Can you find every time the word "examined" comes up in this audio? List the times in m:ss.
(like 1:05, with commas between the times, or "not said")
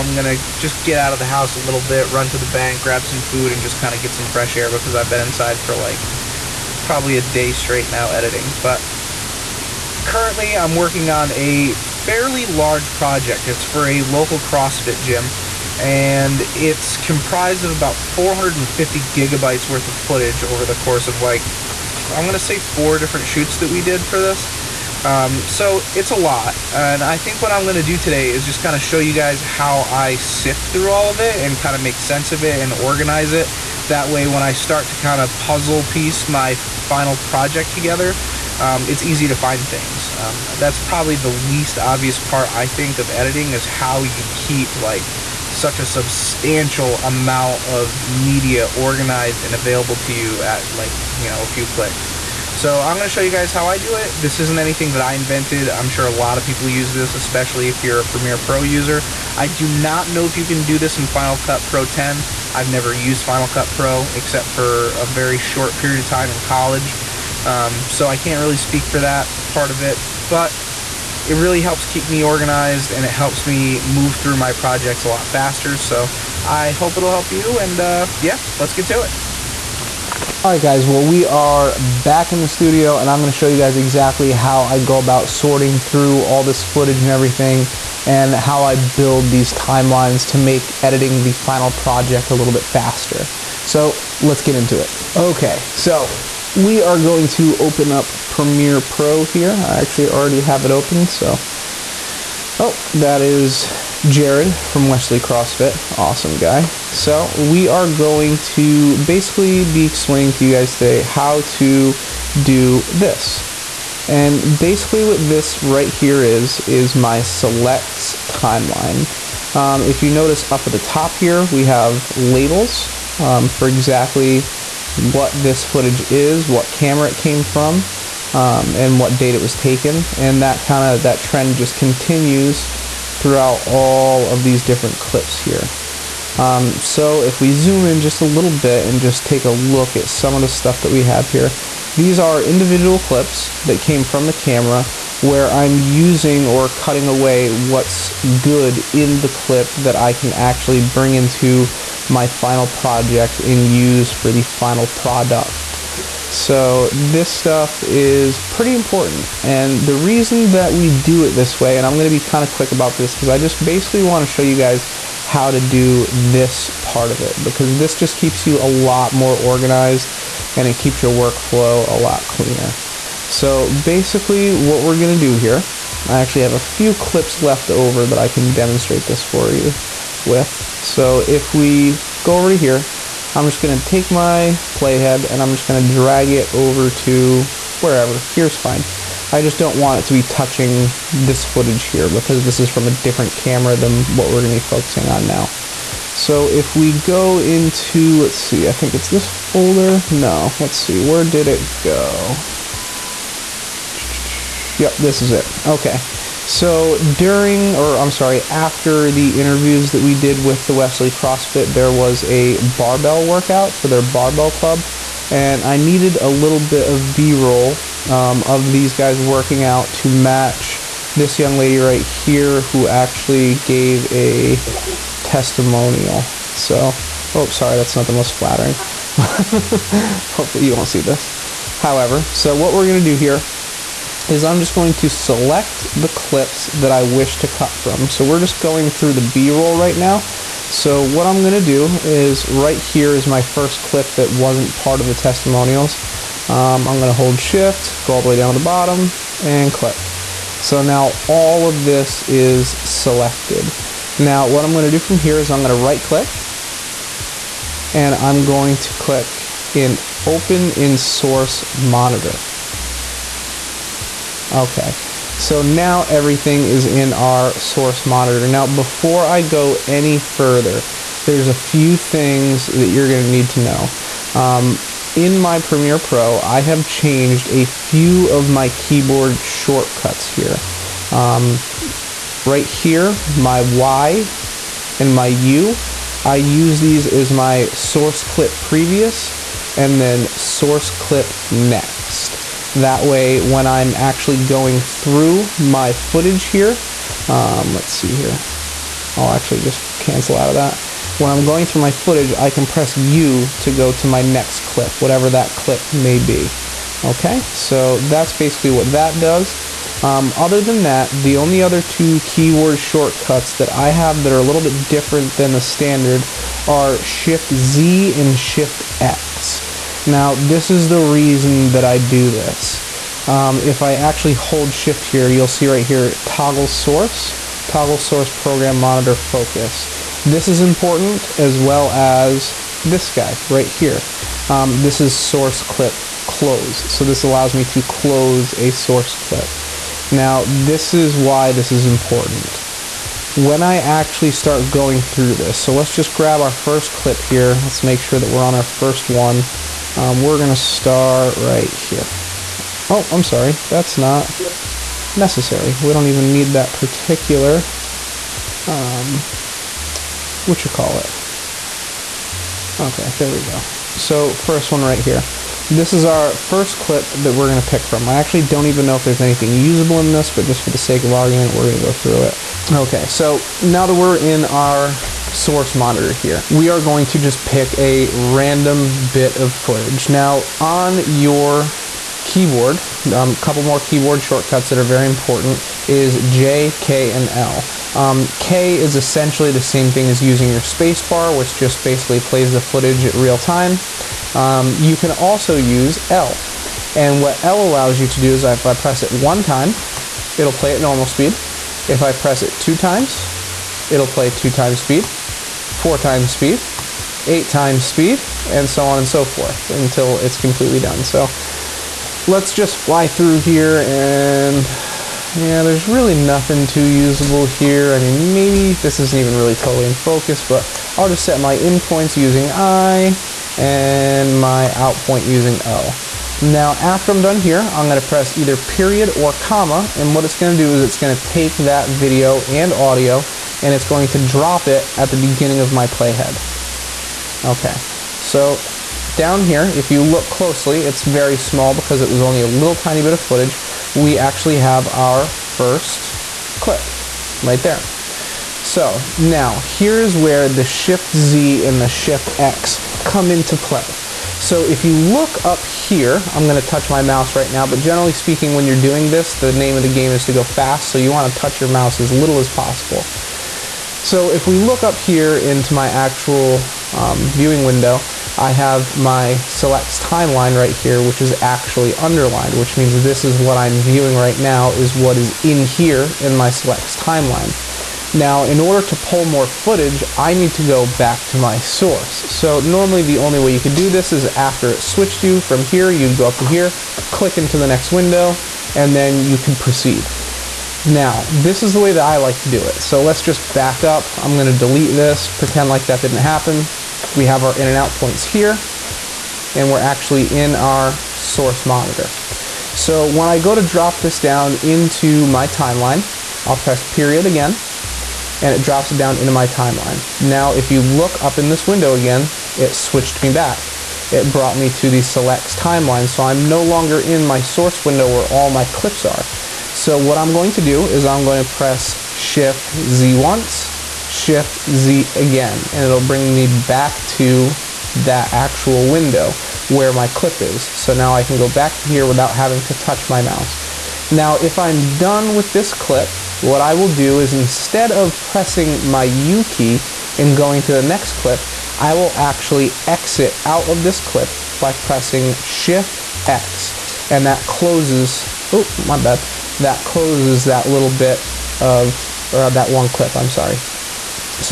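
not said.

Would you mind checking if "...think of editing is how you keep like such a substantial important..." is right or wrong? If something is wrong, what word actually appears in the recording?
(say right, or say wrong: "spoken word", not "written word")
wrong: "amount", not "important".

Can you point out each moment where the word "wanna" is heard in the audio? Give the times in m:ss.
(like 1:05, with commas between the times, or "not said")
2:44, 7:41.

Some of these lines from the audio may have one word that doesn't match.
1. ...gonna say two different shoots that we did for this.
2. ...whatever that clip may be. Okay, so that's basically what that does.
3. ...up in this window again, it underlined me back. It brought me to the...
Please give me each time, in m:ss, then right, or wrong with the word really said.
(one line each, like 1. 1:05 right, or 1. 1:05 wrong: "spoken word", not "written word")
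1. 0:22 wrong: "four", not "two"
2. 5:04 right
3. 8:31 wrong: "switched", not "underlined".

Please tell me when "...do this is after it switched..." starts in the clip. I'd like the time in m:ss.
8:03.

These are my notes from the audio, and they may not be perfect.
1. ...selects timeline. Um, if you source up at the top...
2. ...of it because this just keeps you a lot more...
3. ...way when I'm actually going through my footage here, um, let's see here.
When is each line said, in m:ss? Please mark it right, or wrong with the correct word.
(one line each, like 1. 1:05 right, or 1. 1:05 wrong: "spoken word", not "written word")
1. 1:57 wrong: "notice", not "source"
2. 2:47 right
3. 4:53 right.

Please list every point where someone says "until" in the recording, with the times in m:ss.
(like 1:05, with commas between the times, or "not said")
6:49.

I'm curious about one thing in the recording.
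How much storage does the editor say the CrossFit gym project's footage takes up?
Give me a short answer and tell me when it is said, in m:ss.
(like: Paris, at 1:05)
450 gigabytes, at 0:17.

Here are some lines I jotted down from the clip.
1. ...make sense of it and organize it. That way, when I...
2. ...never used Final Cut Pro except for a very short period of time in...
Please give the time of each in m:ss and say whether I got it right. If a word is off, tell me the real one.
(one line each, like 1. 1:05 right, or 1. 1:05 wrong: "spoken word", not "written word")
1. 0:31 right
2. 1:02 right.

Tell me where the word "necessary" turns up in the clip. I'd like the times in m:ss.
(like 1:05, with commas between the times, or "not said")
5:55.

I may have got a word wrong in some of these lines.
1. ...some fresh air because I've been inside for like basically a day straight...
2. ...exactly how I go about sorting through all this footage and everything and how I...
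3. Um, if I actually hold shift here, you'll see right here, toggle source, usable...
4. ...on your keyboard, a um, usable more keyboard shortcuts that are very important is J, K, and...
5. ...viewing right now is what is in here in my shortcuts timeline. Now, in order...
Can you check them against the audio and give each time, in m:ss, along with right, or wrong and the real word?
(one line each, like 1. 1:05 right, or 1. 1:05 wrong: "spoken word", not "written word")
1. 0:04 wrong: "probably", not "basically"
2. 1:23 right
3. 5:23 wrong: "toggle", not "usable"
4. 6:20 wrong: "couple", not "usable"
5. 7:53 wrong: "selects", not "shortcuts".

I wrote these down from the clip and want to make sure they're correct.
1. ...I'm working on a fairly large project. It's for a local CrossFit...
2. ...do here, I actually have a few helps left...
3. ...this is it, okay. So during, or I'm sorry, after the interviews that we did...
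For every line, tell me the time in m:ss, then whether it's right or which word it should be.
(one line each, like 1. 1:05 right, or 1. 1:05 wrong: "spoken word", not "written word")
1. 0:10 right
2. 2:55 wrong: "clips", not "helps"
3. 3:24 right.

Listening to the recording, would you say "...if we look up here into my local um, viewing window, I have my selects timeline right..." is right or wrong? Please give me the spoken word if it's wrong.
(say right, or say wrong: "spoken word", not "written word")
wrong: "actual", not "local".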